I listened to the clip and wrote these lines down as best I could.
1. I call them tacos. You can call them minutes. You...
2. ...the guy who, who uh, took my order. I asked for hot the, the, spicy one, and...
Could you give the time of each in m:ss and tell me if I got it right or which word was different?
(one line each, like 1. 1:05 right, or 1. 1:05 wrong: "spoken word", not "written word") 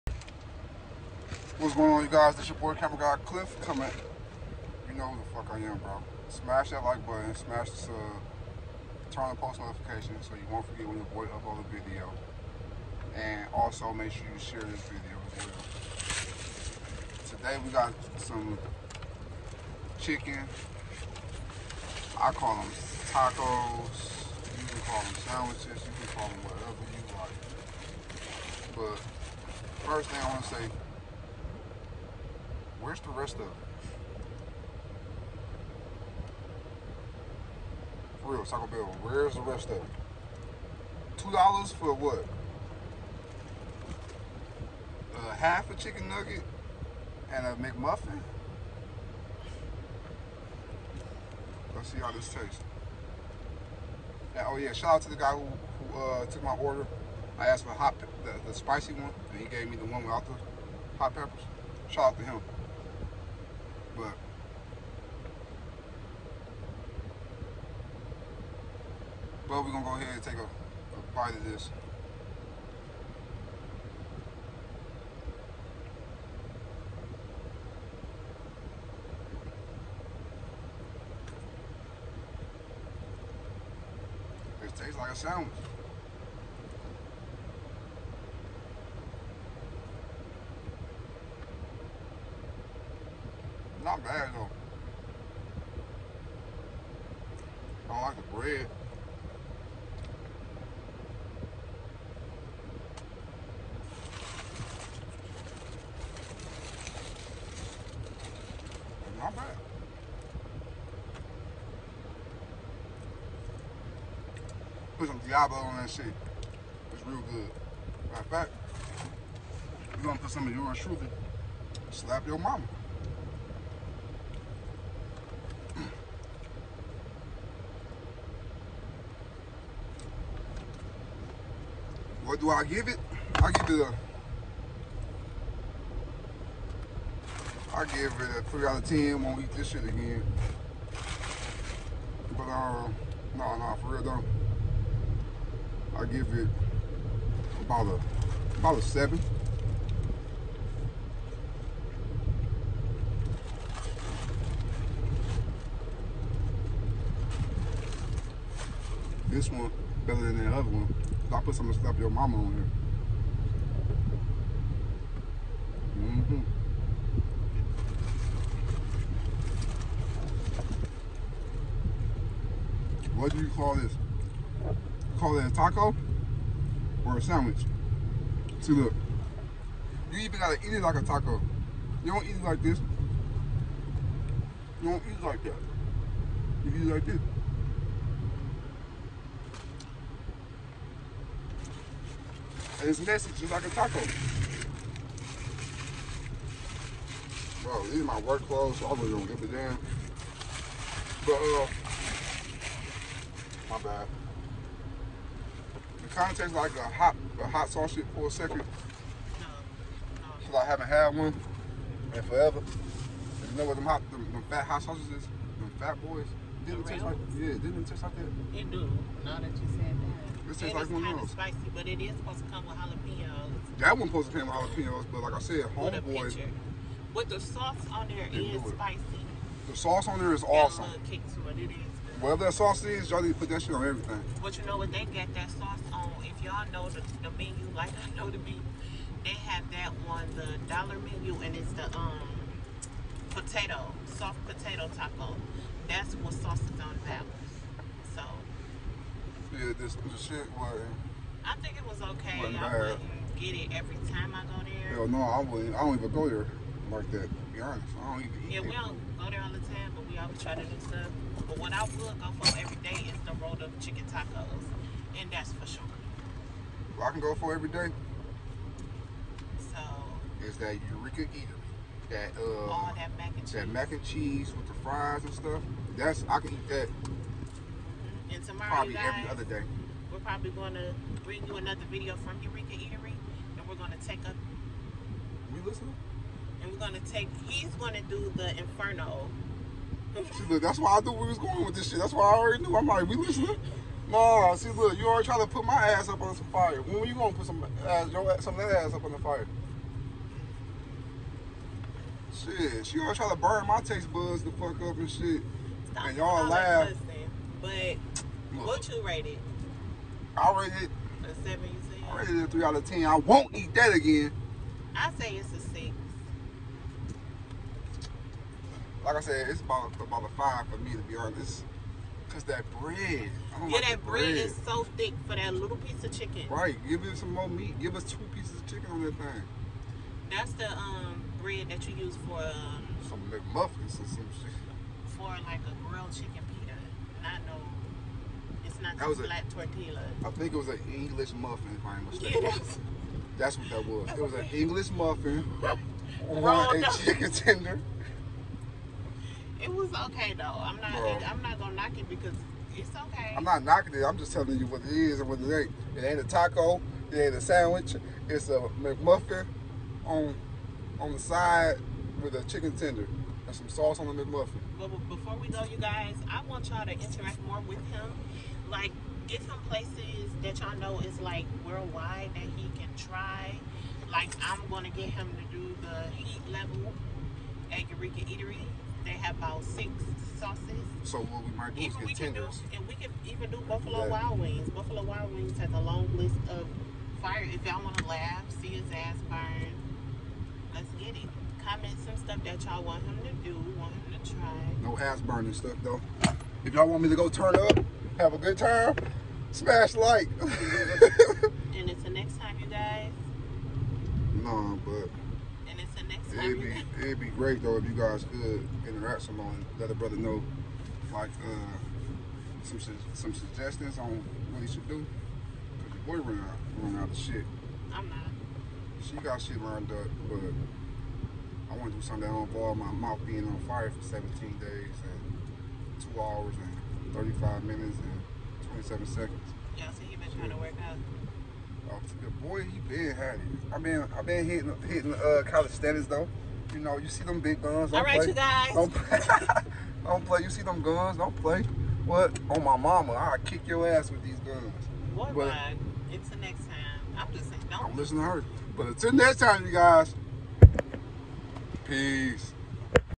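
1. 0:22 wrong: "sandwiches", not "minutes"
2. 0:55 right.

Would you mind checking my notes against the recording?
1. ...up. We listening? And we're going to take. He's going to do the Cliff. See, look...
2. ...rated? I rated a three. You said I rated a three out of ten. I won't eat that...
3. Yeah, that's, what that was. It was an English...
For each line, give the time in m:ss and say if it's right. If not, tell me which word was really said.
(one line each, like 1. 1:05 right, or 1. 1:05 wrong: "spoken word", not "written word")
1. 4:44 wrong: "Inferno", not "Cliff"
2. 5:09 wrong: "seven", not "three"
3. 5:42 right.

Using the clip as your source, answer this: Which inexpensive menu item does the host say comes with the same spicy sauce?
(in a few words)
soft potato taco.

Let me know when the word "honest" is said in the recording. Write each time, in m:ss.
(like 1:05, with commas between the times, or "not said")
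4:17, 5:21.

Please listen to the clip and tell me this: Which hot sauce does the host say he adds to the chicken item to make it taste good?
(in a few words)
Diablo.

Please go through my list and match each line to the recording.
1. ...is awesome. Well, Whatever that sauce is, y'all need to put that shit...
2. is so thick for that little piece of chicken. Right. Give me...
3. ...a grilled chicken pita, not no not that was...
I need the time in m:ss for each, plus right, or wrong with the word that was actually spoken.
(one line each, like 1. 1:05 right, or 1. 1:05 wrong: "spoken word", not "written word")
1. 3:50 right
2. 5:24 right
3. 5:35 right.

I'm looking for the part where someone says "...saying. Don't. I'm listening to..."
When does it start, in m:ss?
7:27.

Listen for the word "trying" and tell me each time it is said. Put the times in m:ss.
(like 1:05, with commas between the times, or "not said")
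4:55, 5:03, 7:10.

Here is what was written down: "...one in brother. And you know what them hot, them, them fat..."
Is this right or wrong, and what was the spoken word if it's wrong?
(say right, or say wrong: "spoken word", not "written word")
wrong: "forever", not "brother".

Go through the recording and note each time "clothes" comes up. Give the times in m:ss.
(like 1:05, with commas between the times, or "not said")
3:18.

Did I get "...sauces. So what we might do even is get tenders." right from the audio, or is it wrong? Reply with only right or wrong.
right.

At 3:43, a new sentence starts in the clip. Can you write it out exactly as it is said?
That one supposed to come with jalapenos, but like I said, homeboy.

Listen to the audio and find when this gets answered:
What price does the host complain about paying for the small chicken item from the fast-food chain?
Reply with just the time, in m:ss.
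0:41.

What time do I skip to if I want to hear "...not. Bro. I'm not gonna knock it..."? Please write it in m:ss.
5:50.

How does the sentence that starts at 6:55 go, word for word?
Cause your boy run out, run out of shit.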